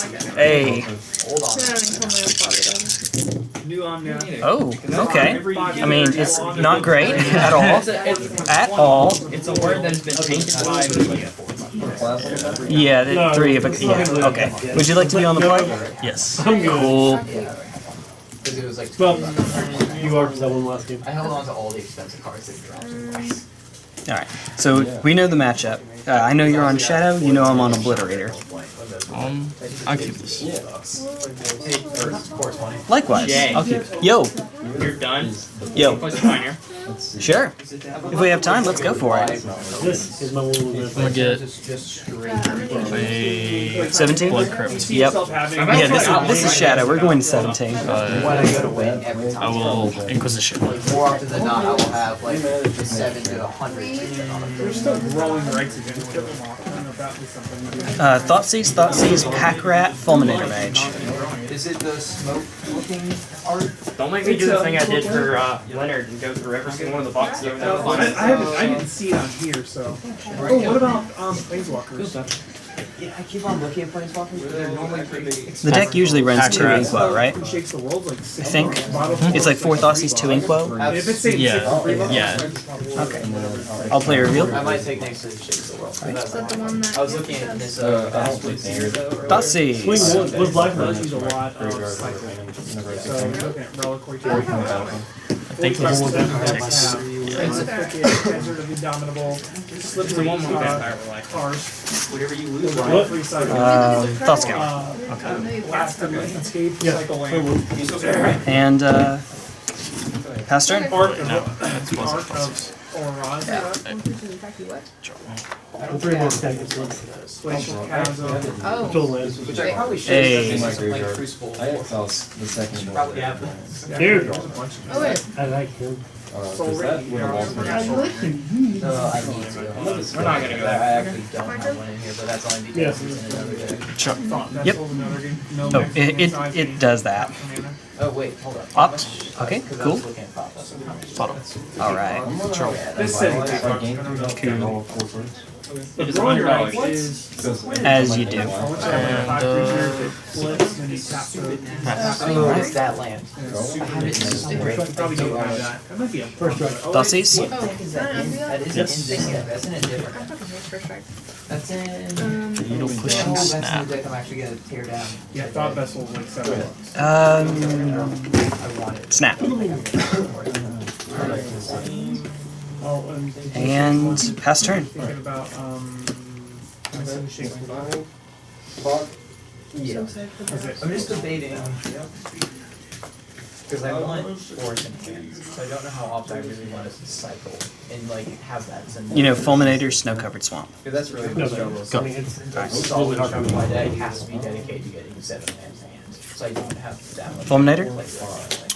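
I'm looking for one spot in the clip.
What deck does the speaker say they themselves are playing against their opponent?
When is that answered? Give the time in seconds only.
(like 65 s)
27 s.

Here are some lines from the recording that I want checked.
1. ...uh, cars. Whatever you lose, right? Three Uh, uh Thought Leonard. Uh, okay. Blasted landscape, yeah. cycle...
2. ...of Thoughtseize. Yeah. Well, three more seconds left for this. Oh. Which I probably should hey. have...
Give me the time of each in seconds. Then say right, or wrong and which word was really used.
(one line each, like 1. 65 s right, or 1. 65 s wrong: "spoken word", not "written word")
1. 100 s wrong: "Scour", not "Leonard"
2. 112 s wrong: "Oron", not "Thoughtseize".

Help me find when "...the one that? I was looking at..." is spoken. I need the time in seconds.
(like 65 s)
86 s.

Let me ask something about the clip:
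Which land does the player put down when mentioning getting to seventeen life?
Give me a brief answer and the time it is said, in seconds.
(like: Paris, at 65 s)
Blood Crypt, at 44 s.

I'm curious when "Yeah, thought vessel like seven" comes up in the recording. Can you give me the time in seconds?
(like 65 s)
165 s.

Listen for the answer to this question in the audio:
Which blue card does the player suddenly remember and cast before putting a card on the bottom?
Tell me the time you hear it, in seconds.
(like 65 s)
138 s.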